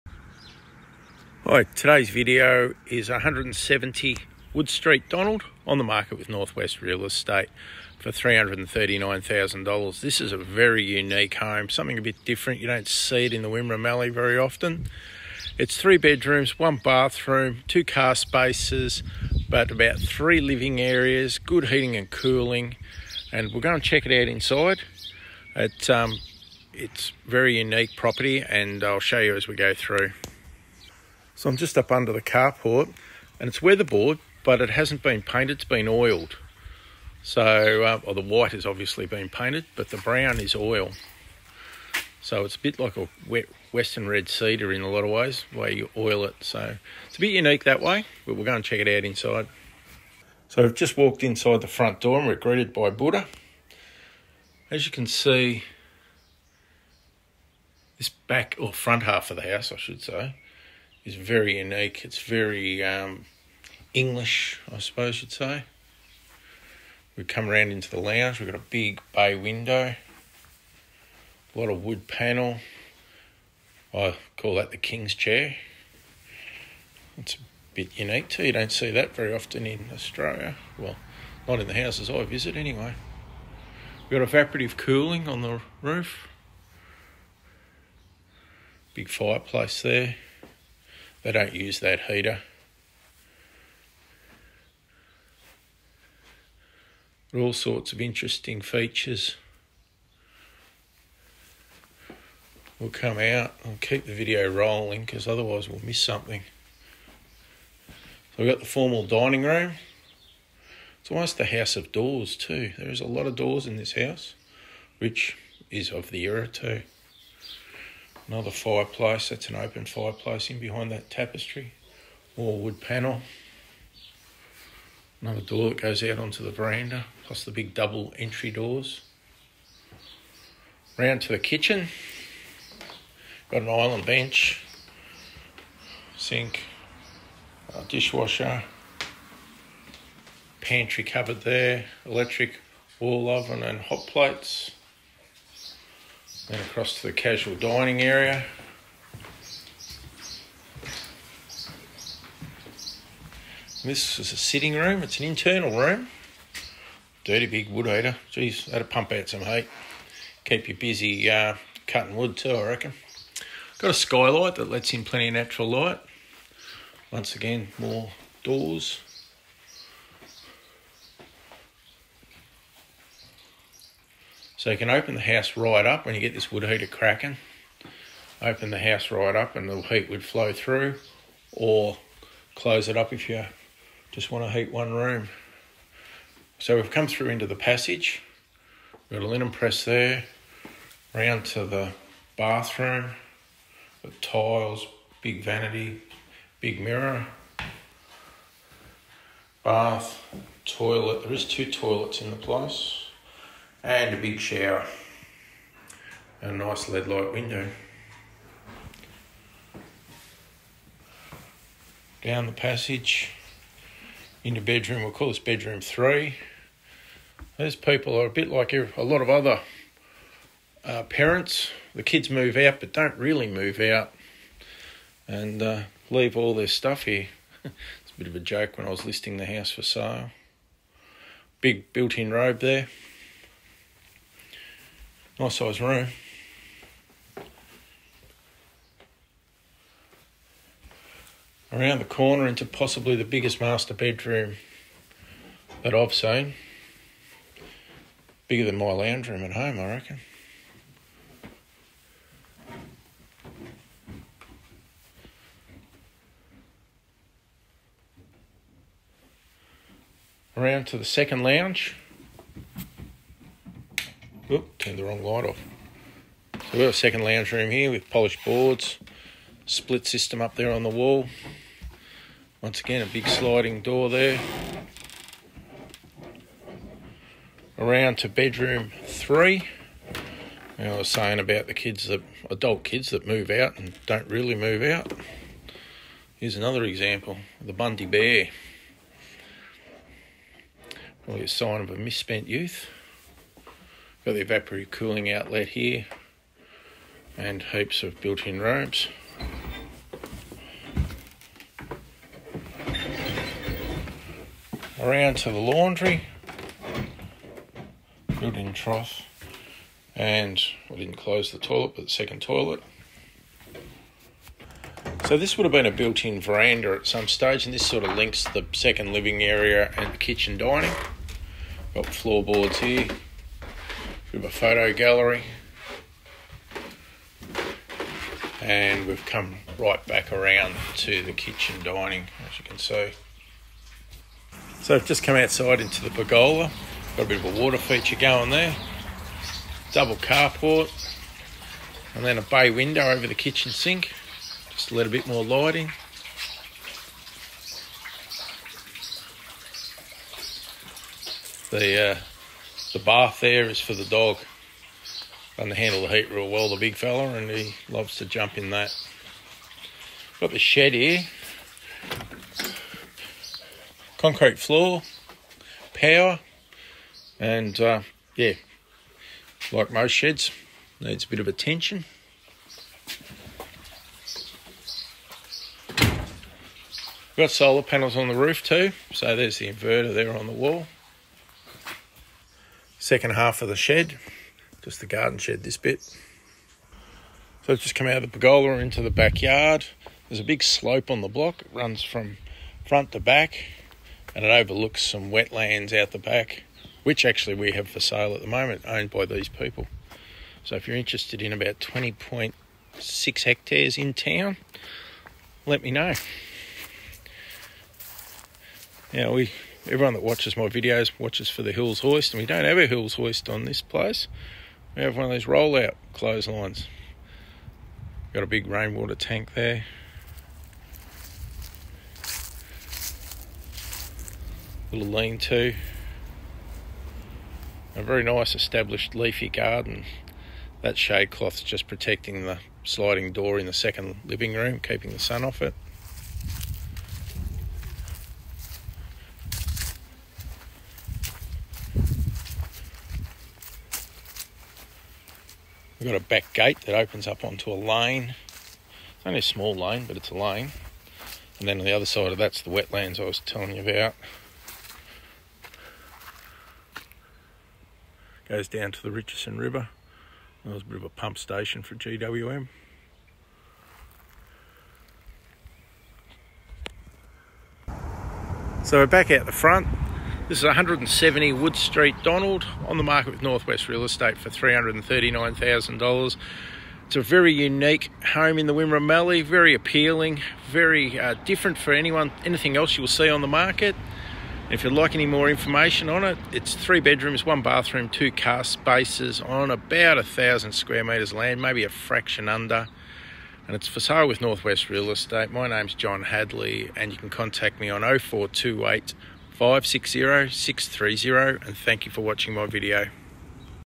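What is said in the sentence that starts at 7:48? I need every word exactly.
So we're back out the front.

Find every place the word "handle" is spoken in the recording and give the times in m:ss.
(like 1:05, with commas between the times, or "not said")
5:55.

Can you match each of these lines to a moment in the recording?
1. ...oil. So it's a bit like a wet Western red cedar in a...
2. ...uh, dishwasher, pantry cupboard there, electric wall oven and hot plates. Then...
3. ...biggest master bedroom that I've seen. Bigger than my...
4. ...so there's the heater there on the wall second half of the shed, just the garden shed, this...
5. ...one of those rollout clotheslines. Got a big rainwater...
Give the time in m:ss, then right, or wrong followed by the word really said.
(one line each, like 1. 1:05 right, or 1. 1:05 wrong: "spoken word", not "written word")
1. 0:40 right
2. 2:17 right
3. 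4:03 right
4. 6:19 wrong: "inverter", not "heater"
5. 6:55 right.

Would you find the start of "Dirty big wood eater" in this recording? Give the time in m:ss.
2:37.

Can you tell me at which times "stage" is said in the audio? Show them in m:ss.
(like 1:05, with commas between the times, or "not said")
5:17.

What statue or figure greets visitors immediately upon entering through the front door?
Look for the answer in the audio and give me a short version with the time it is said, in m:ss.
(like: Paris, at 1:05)
Buddha, at 0:52.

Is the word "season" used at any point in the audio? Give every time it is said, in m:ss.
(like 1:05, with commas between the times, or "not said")
not said.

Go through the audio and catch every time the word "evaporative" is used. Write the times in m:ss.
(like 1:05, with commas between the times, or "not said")
1:24, 4:54.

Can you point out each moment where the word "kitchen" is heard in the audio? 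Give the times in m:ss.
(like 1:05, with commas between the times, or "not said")
2:11, 5:20, 5:31, 5:43.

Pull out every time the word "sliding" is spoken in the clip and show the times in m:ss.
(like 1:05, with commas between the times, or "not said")
4:33, 7:12.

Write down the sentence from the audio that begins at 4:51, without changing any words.
Probably a sign of a misspent youth.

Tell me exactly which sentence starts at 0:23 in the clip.
And we'll go and check it out inside.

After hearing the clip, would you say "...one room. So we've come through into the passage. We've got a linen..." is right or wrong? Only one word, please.
right.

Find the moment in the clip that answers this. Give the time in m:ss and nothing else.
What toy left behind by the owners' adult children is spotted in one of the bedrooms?
4:47.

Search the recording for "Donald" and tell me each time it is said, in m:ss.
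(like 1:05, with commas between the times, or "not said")
0:05, 7:52.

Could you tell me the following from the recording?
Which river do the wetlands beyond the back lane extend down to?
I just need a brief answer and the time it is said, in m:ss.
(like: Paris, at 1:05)
Richardson River, at 7:39.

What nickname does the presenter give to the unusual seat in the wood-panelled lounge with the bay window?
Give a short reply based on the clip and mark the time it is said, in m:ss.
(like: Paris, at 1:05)
The king's chair, at 1:14.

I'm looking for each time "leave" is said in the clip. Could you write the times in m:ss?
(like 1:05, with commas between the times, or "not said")
3:46.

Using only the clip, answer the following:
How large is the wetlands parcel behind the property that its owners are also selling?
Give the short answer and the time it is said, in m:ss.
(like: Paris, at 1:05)
20.6 hectares, at 6:41.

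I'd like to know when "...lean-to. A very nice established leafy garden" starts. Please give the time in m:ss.
7:05.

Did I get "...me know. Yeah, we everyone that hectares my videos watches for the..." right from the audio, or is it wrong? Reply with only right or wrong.
wrong.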